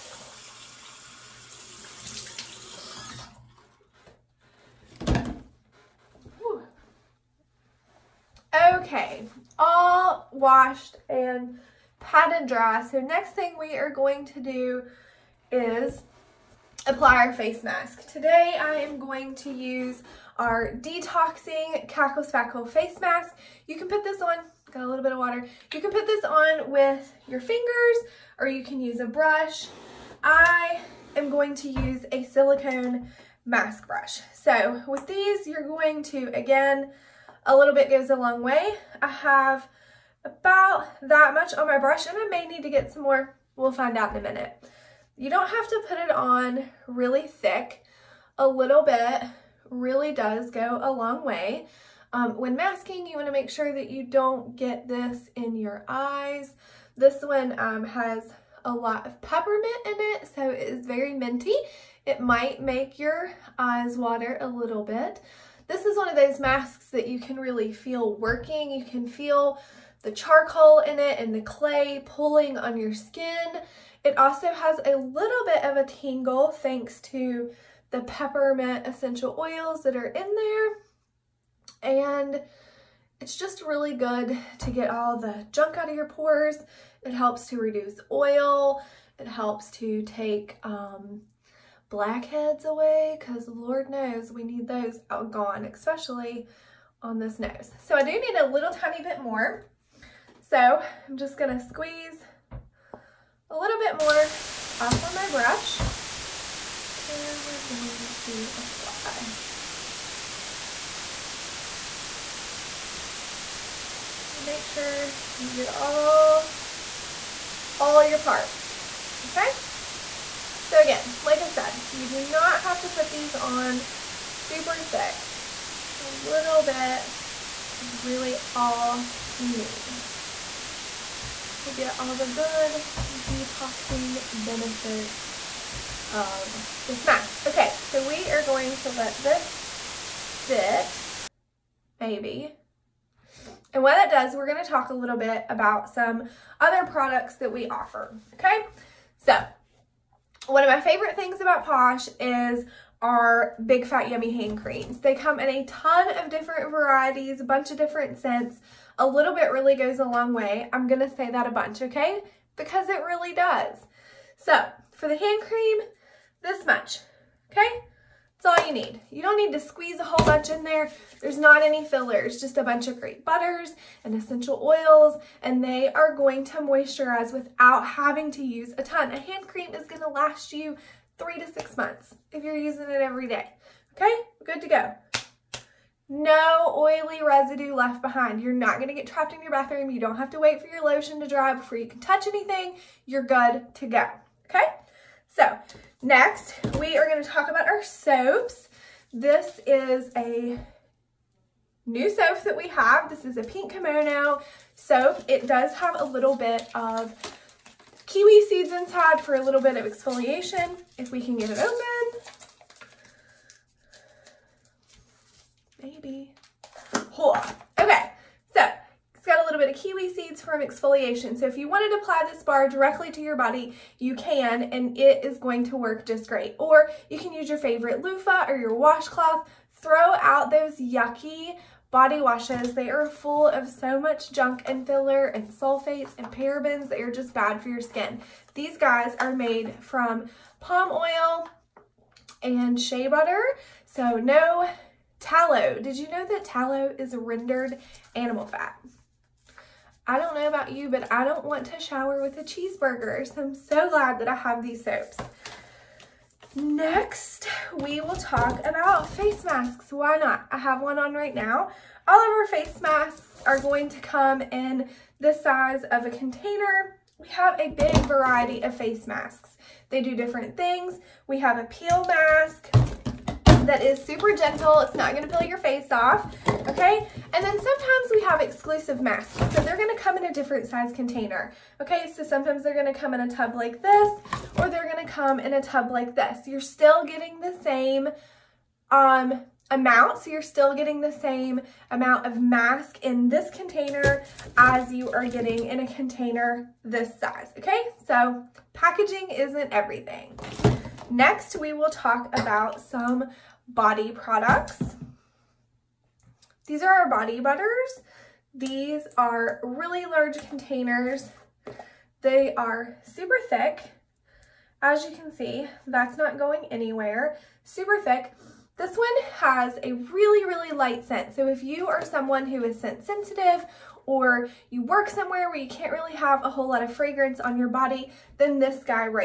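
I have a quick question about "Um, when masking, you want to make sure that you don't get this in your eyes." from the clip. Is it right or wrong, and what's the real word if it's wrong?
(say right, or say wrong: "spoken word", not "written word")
right.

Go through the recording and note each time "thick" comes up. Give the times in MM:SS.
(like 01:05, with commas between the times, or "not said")
00:47, 02:04, 05:13, 05:18.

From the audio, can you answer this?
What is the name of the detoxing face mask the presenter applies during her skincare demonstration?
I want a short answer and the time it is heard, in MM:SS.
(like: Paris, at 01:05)
Cackle Spackle, at 00:21.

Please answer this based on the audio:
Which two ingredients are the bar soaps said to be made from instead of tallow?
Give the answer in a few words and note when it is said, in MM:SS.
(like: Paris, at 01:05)
palm oil and shea butter, at 04:00.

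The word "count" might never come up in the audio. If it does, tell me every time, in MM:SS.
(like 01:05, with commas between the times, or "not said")
not said.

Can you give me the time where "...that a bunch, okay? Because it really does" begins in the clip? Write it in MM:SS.
02:41.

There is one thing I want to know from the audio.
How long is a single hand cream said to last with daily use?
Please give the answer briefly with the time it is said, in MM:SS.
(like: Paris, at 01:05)
3 to 6 months, at 03:01.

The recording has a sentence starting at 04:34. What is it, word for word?
It's not going to peel your face off, okay?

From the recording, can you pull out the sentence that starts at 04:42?
So sometimes they're going to come in a tub like this, or they're going to come in a tub like this.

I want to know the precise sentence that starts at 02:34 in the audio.
They come in a ton of different varieties, a bunch of different scents.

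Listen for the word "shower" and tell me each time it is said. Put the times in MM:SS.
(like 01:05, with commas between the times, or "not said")
04:11.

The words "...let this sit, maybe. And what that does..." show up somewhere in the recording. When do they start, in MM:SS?
02:18.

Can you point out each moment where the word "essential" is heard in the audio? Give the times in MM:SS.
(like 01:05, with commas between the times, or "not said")
01:18, 02:54.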